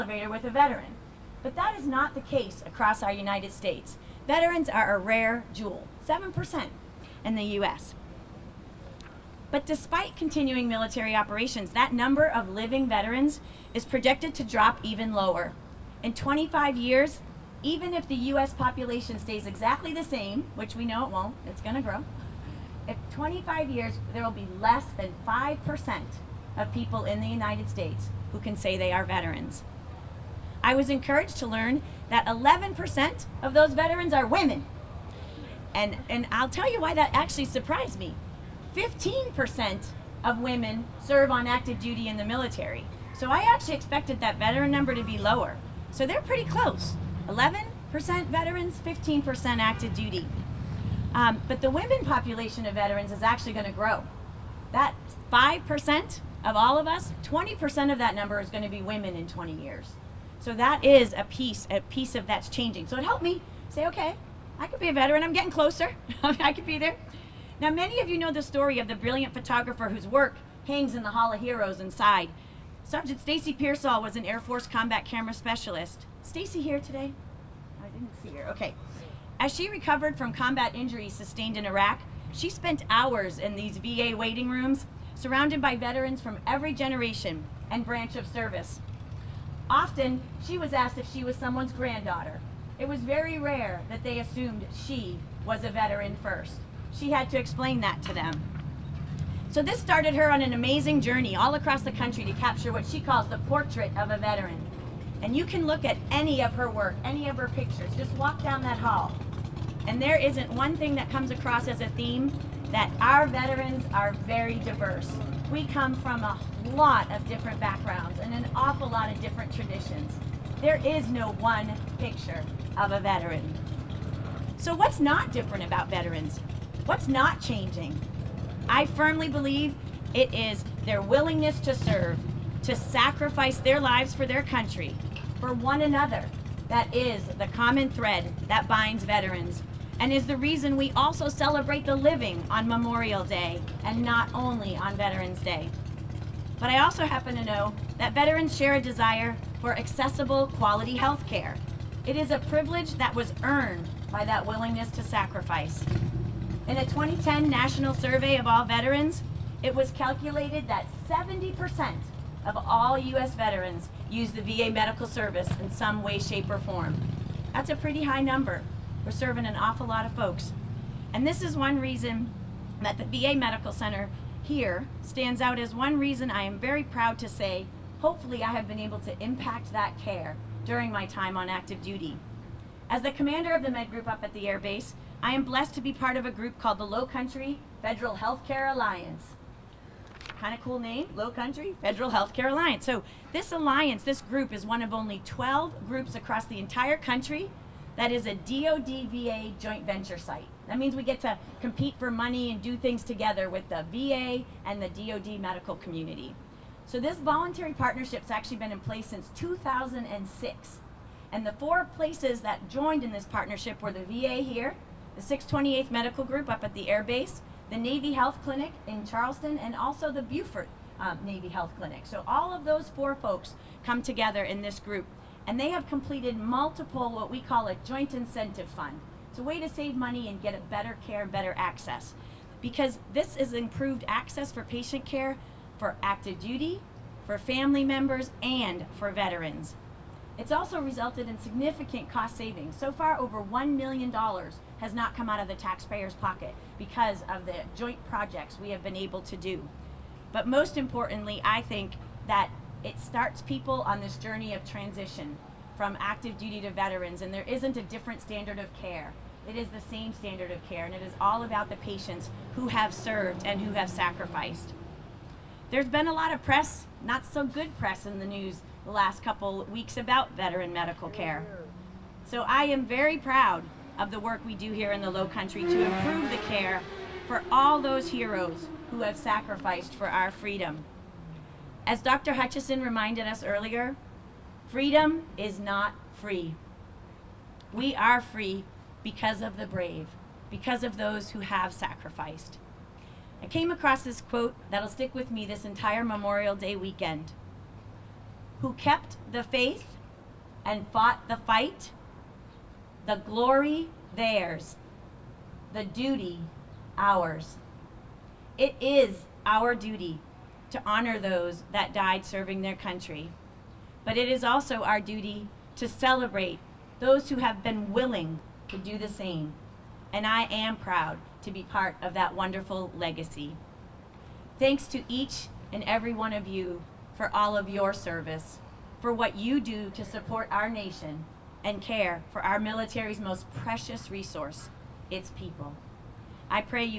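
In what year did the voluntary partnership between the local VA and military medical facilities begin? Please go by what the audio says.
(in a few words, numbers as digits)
2006.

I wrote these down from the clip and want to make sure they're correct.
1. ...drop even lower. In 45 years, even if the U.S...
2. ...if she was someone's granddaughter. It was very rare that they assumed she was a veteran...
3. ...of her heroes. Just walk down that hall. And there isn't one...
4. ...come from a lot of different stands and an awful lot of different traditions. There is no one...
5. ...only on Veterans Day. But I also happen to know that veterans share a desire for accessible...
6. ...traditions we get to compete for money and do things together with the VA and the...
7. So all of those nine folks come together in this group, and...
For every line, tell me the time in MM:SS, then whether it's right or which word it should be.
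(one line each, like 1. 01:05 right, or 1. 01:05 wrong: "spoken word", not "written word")
1. 00:14 wrong: "25", not "45"
2. 01:30 right
3. 01:47 wrong: "pictures", not "heroes"
4. 01:55 wrong: "backgrounds", not "stands"
5. 02:24 right
6. 03:20 wrong: "means", not "traditions"
7. 03:42 wrong: "four", not "nine".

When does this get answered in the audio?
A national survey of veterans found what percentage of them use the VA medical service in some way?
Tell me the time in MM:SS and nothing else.
02:41.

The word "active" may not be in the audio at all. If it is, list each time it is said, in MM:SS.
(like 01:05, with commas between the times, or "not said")
00:41, 00:49, 03:01, 03:56, 04:16.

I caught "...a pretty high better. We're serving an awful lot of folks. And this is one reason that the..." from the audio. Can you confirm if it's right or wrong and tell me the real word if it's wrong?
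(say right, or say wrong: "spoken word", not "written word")
wrong: "number", not "better".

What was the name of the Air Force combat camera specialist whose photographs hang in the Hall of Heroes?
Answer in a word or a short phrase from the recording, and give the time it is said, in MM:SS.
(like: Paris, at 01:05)
Stacy Pearsall, at 01:13.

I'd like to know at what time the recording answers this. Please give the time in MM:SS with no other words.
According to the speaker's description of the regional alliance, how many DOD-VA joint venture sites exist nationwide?
03:15.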